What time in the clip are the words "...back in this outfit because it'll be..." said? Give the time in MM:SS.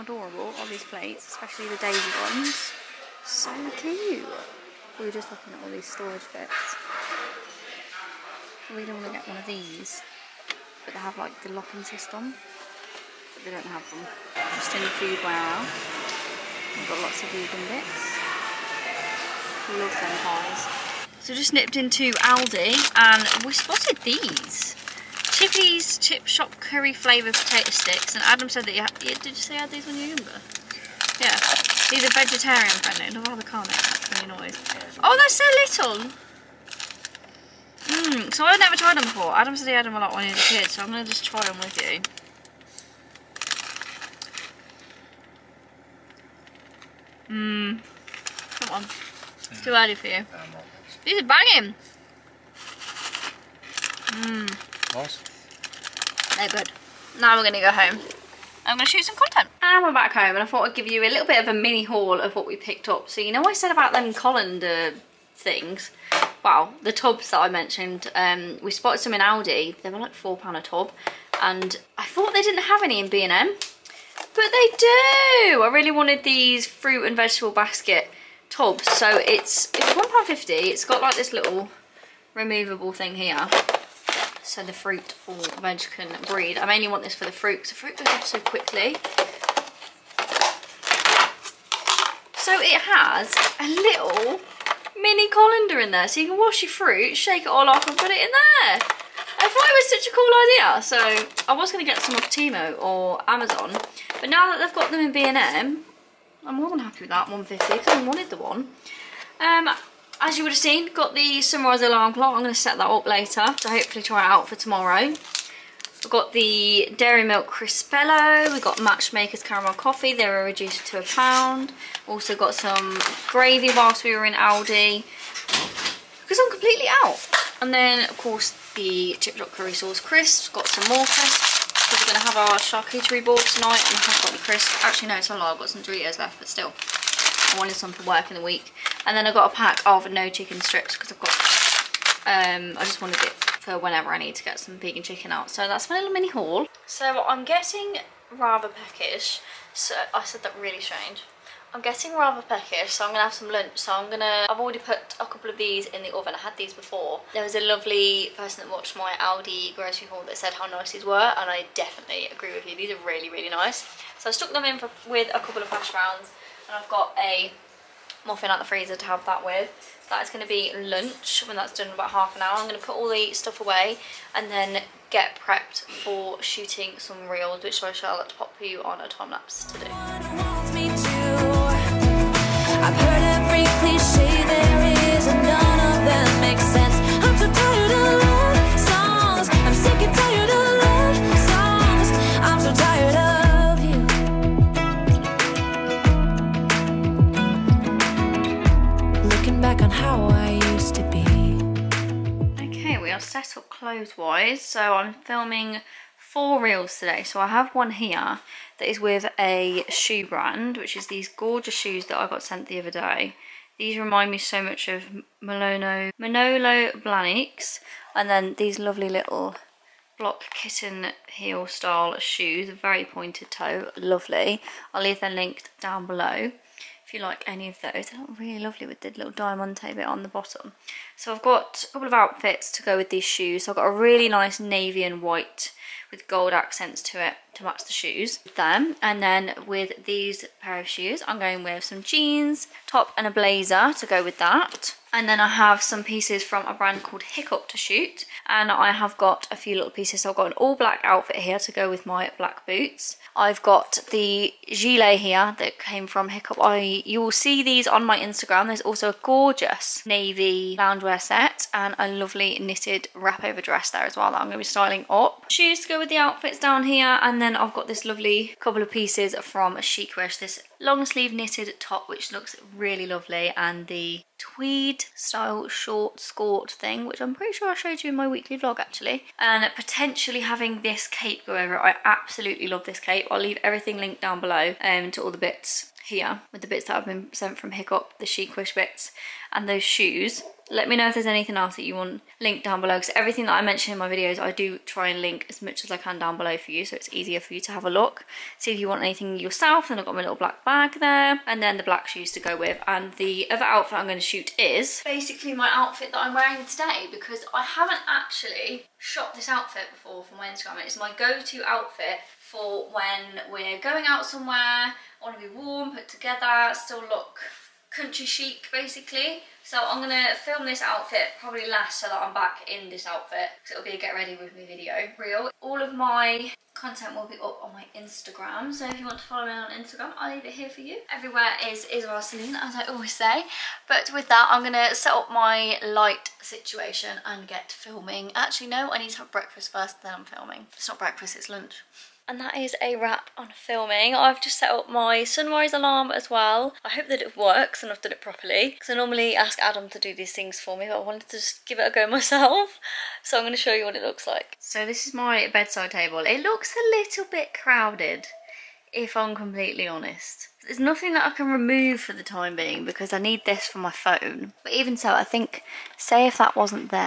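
05:22.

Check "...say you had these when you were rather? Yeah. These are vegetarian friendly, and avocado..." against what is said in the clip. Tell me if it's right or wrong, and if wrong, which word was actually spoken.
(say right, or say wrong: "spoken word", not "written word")
wrong: "younger", not "rather".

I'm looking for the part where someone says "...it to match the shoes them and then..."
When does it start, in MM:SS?
03:57.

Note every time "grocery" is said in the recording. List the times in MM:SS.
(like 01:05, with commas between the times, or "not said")
02:39.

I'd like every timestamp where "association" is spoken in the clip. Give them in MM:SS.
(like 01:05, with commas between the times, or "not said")
not said.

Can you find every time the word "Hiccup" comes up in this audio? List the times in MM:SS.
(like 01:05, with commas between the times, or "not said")
04:07, 04:16, 04:47.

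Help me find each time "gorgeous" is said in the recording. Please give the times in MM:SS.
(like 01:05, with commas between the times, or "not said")
03:31, 04:19.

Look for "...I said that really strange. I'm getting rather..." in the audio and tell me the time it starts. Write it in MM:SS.
02:30.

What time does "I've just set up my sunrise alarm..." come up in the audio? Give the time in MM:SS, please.
05:44.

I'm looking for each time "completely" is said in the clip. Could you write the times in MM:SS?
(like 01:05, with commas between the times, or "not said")
02:06, 05:59.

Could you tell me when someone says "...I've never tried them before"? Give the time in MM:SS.
00:38.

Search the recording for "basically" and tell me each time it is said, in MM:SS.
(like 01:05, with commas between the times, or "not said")
05:05, 05:18.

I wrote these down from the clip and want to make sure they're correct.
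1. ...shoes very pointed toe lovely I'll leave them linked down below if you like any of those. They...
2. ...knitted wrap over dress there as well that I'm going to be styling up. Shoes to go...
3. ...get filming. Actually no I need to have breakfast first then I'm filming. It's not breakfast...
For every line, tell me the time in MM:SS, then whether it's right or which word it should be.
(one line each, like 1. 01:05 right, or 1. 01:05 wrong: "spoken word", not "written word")
1. 03:42 right
2. 04:22 right
3. 05:37 right.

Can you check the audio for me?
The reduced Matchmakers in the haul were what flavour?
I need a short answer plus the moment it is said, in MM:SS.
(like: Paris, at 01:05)
Caramel Coffee, at 01:59.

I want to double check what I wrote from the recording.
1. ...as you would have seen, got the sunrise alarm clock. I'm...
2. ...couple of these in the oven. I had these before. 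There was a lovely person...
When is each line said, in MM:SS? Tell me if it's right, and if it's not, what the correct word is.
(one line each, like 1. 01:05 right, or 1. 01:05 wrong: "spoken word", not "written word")
1. 01:50 right
2. 02:35 right.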